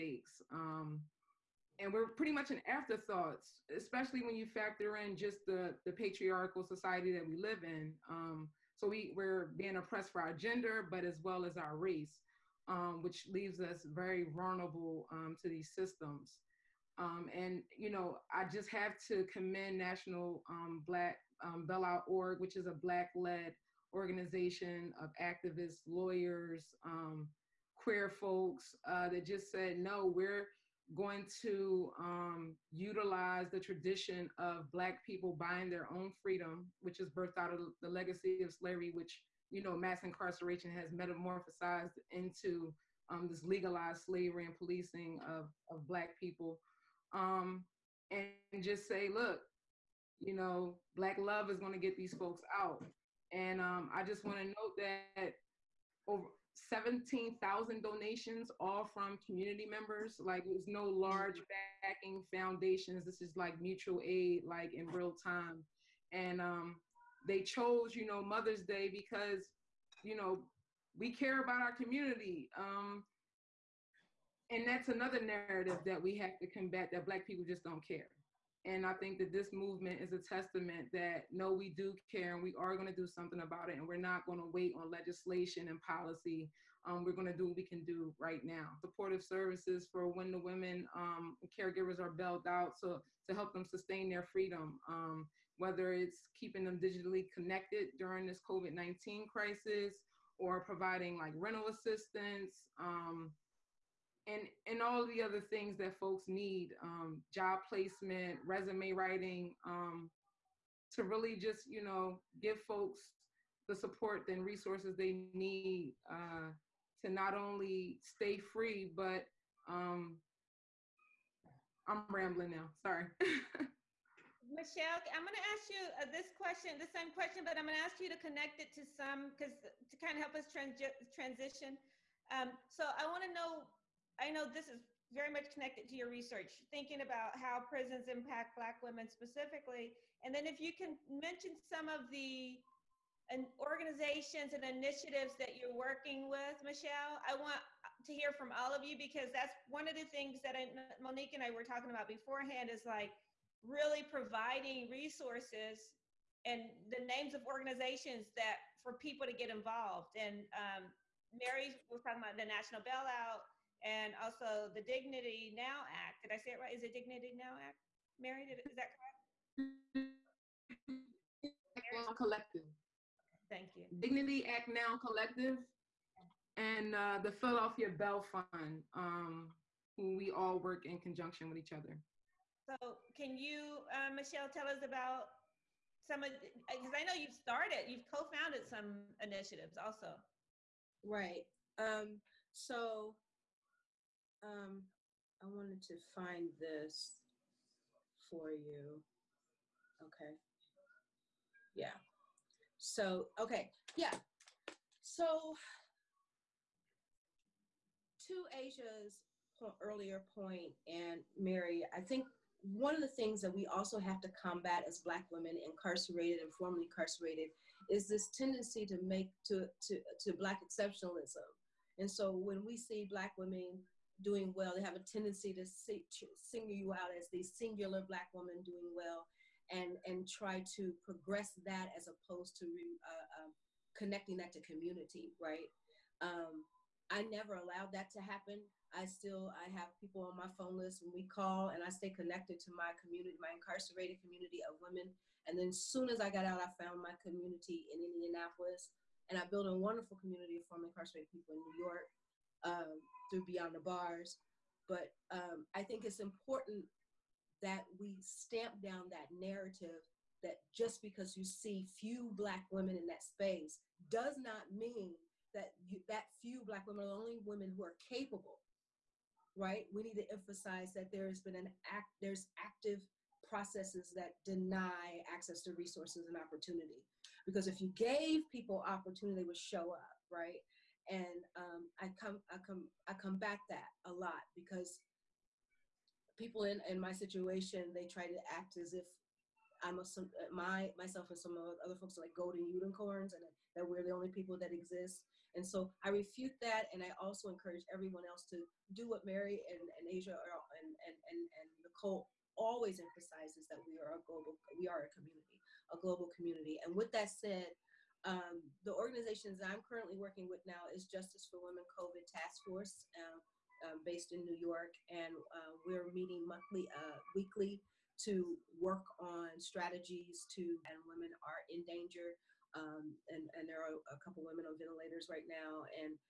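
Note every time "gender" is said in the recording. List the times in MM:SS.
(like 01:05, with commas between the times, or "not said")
00:10.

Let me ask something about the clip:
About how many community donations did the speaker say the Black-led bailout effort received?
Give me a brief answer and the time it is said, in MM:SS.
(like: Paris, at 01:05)
17,000, at 00:56.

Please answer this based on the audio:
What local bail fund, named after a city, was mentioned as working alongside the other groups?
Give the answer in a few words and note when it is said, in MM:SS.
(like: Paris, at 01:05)
Philadelphia Bail Fund, at 02:57.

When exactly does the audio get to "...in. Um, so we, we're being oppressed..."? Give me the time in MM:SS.
00:07.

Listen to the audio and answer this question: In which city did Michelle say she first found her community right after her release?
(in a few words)
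Indianapolis.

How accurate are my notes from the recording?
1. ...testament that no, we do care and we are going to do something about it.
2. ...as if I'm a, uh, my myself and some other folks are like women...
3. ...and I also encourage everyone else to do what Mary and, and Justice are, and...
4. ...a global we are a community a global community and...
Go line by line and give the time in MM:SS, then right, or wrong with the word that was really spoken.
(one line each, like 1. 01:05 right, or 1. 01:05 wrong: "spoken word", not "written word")
1. 01:20 right
2. 04:48 wrong: "golden", not "women"
3. 04:56 wrong: "Asia", not "Justice"
4. 05:04 right.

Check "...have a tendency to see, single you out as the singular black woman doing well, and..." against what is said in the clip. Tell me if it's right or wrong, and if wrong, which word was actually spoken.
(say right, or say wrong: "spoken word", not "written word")
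right.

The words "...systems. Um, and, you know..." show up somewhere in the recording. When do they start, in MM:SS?
00:15.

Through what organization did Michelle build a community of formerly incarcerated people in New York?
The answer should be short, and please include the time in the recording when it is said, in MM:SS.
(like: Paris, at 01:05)
Beyond the Bars, at 04:13.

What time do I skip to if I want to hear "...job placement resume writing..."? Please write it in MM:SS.
01:47.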